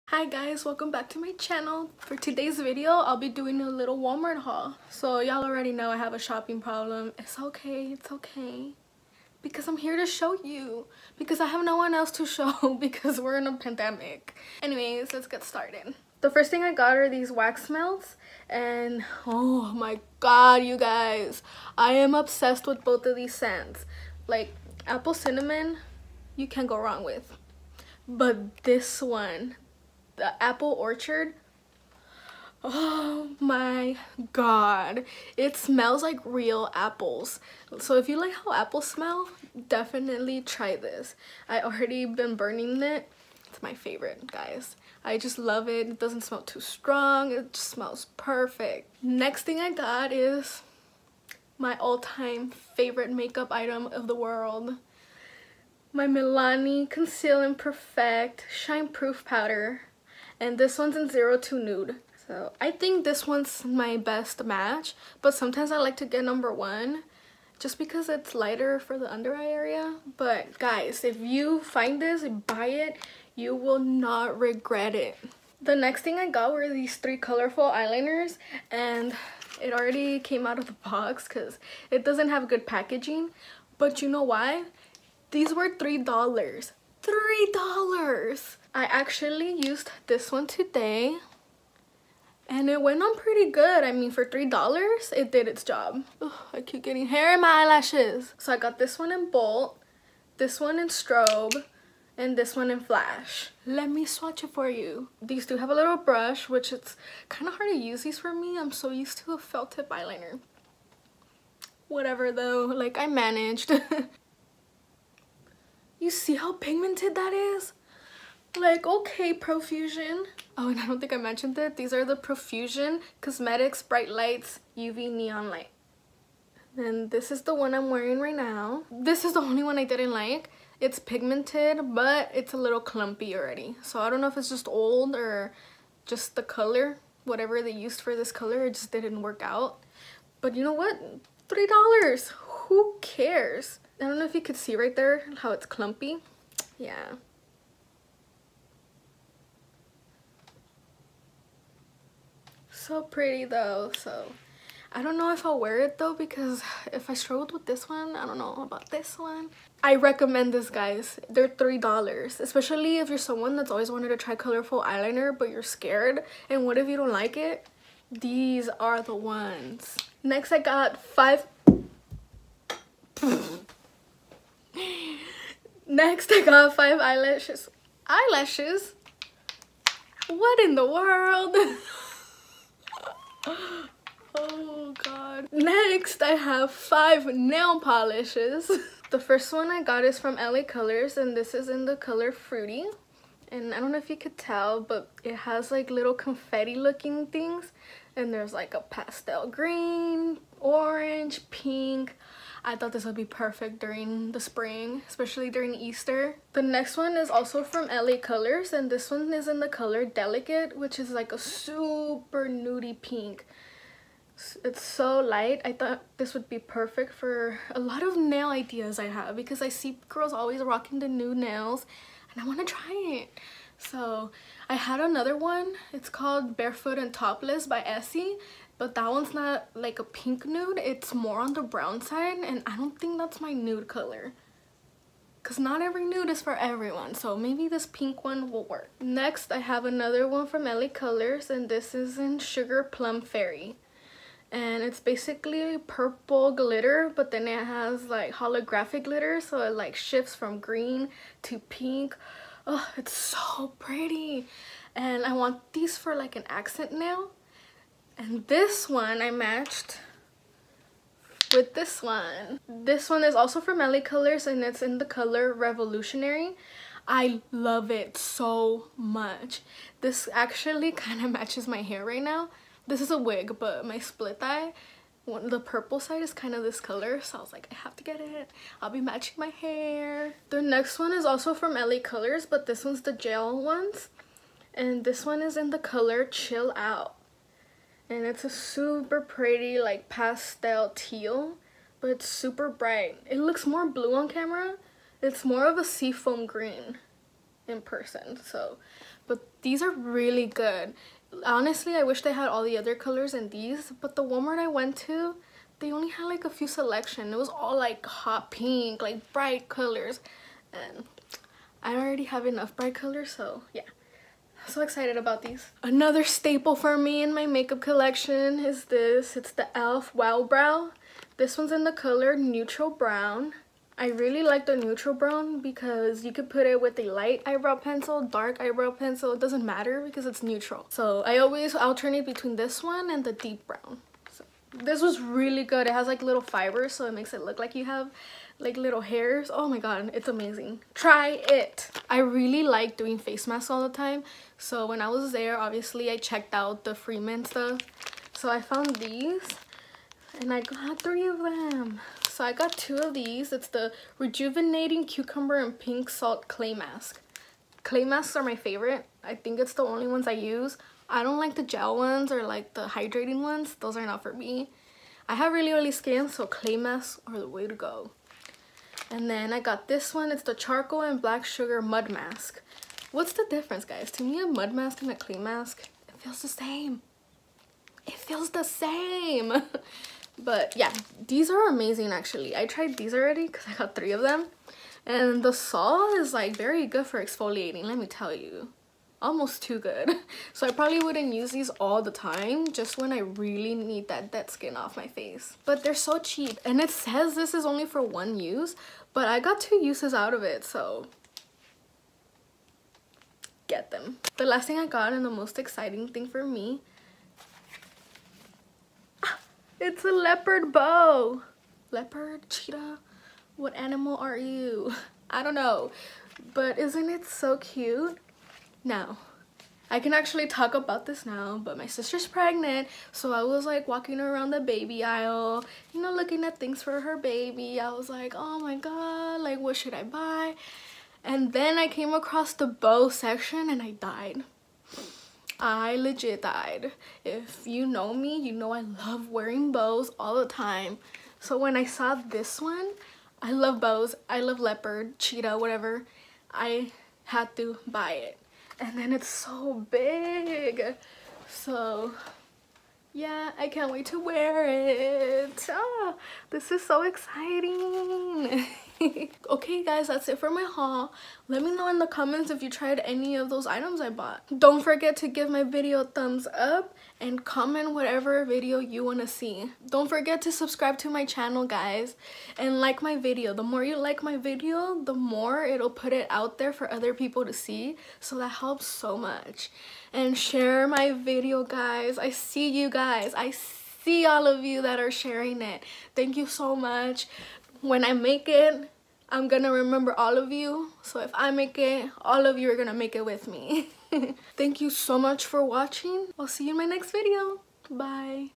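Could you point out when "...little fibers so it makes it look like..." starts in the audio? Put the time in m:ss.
5:36.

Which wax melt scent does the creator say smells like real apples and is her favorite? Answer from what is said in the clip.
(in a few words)
Apple orchard.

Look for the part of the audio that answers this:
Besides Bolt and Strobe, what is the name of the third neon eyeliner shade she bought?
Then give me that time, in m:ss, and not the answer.
1:42.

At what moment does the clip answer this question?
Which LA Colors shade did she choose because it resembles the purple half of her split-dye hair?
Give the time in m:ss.
4:25.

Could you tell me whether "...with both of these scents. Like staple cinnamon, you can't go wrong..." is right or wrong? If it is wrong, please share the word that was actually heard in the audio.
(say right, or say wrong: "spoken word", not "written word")
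wrong: "apple", not "staple".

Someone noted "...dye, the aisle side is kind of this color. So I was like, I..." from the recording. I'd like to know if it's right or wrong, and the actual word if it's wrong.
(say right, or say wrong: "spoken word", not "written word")
wrong: "purple", not "aisle".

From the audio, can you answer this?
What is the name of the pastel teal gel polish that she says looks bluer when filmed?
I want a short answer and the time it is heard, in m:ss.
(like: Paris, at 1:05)
Chill Out, at 4:46.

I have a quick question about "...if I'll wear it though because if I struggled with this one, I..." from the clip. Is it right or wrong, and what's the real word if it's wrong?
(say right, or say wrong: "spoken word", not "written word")
right.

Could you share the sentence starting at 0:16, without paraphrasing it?
The first thing I got are these wax melts.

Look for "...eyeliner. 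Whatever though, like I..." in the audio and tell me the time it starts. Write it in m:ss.
1:49.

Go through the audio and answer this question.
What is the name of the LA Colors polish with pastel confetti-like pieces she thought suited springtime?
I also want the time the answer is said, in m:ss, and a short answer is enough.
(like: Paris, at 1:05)
Fruity, at 3:12.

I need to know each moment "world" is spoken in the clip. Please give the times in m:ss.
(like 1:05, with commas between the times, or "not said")
0:54, 3:00.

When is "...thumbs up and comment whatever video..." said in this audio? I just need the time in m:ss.
7:46.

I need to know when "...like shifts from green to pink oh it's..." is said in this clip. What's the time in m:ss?
4:09.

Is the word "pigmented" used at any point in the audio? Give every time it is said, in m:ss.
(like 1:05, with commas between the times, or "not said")
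1:56, 2:10.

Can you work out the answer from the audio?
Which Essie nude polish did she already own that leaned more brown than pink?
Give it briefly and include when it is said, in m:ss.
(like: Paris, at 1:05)
Barefoot and Topless, at 3:46.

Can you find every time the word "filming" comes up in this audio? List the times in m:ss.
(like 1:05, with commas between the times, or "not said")
not said.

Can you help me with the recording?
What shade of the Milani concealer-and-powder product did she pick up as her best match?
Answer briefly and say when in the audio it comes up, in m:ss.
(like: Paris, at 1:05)
02 Nude, at 1:01.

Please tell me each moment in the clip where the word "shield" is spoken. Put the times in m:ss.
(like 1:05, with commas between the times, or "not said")
not said.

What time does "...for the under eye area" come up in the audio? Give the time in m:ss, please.
1:08.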